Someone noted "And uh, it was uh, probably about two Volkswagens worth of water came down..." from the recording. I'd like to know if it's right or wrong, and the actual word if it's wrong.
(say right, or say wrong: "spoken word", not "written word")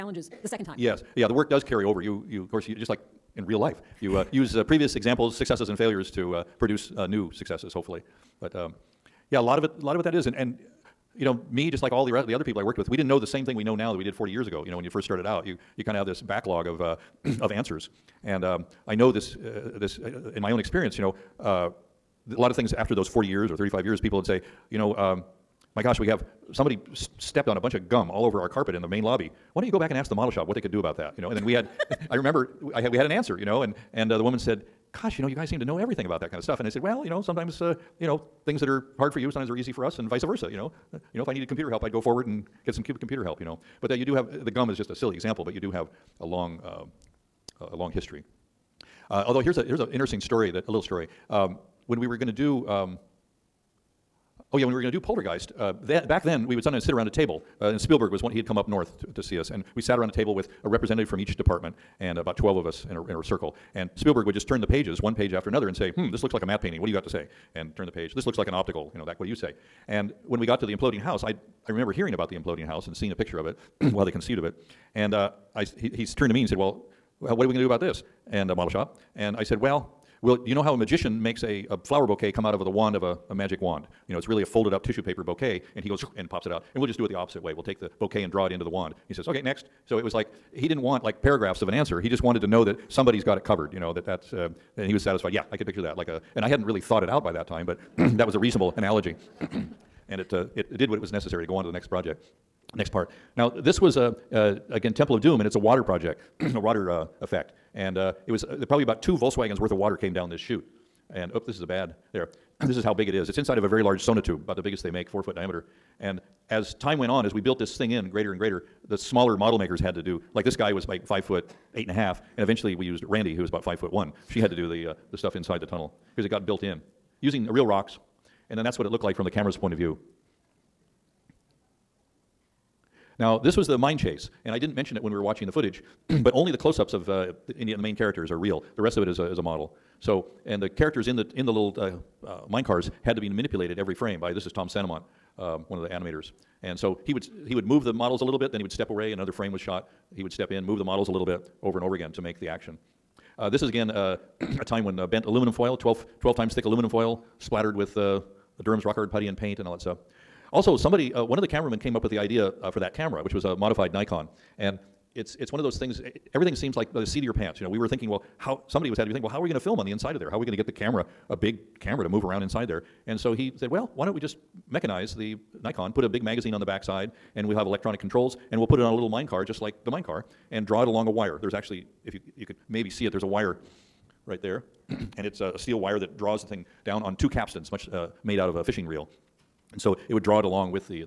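right.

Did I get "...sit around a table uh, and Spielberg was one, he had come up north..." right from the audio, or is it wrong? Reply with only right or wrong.
right.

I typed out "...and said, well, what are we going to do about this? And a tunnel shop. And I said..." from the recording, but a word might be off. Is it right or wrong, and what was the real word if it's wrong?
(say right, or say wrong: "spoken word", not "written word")
wrong: "model", not "tunnel".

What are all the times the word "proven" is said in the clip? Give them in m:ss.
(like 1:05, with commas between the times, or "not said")
not said.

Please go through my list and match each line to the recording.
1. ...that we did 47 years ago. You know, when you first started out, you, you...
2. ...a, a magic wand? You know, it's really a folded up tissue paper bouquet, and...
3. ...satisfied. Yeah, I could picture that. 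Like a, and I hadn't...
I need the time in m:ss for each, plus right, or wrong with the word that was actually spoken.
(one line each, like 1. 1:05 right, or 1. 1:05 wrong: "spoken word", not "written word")
1. 0:13 wrong: "40", not "47"
2. 1:23 right
3. 1:35 right.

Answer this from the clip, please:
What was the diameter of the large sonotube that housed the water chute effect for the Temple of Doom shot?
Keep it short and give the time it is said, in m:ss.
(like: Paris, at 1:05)
4 feet, at 1:55.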